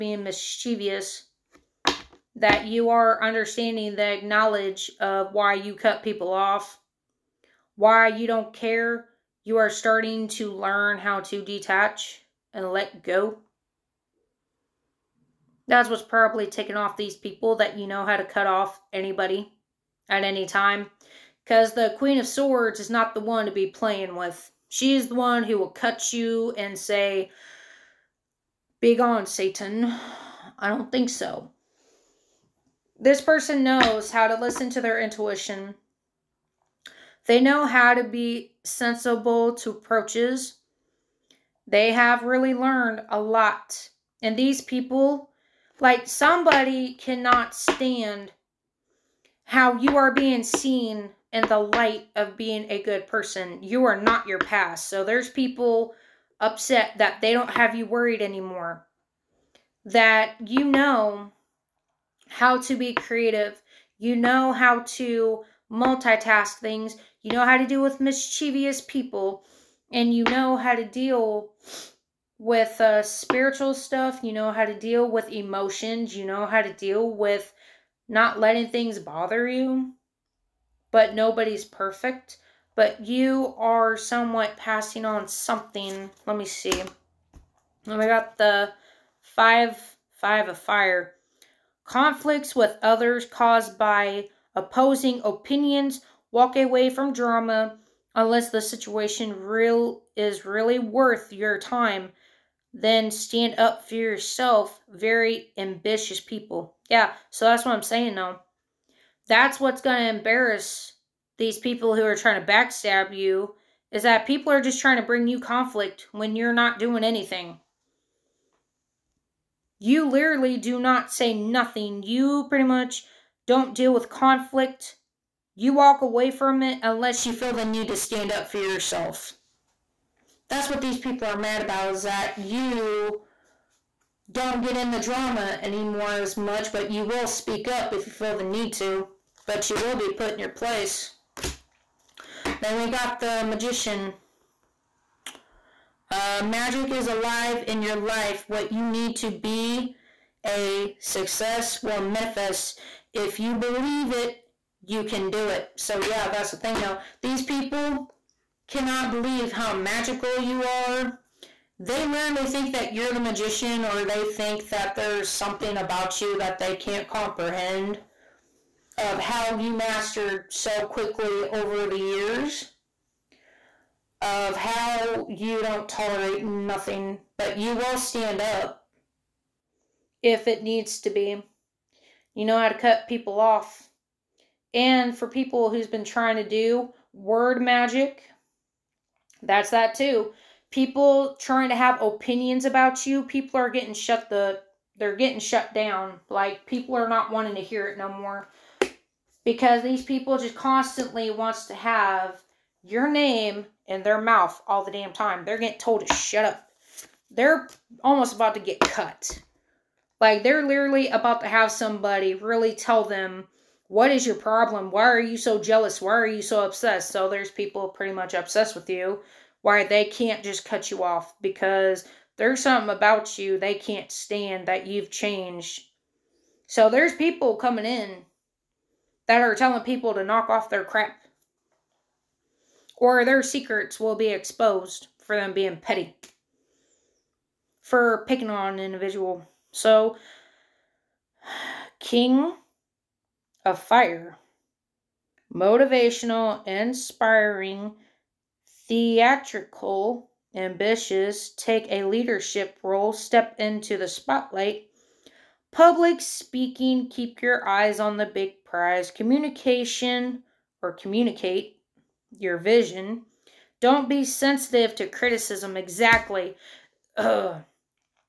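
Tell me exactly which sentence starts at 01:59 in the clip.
You literally do not say nothing.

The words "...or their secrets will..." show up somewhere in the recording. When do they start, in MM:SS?
03:52.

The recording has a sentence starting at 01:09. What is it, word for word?
And you know how to deal with uh, spiritual stuff.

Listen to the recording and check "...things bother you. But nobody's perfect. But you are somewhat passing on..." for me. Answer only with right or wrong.
right.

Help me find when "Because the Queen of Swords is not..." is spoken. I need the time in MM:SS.
00:21.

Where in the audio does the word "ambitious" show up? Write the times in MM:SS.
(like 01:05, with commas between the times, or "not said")
01:45, 04:10.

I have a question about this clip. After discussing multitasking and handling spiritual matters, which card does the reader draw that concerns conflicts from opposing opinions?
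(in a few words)
Five of fire.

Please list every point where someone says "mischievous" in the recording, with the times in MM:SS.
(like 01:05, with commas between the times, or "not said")
00:00, 01:08.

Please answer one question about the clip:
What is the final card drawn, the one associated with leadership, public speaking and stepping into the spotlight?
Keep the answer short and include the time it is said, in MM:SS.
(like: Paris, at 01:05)
King of fire, at 04:01.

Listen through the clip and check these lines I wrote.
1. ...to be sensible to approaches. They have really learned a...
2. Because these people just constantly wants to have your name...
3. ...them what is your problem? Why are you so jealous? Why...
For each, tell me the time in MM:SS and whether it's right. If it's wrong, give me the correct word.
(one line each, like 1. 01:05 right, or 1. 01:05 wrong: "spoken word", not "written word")
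1. 00:37 right
2. 03:19 right
3. 03:33 right.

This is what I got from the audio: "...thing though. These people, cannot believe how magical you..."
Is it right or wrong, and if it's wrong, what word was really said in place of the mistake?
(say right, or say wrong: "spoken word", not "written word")
right.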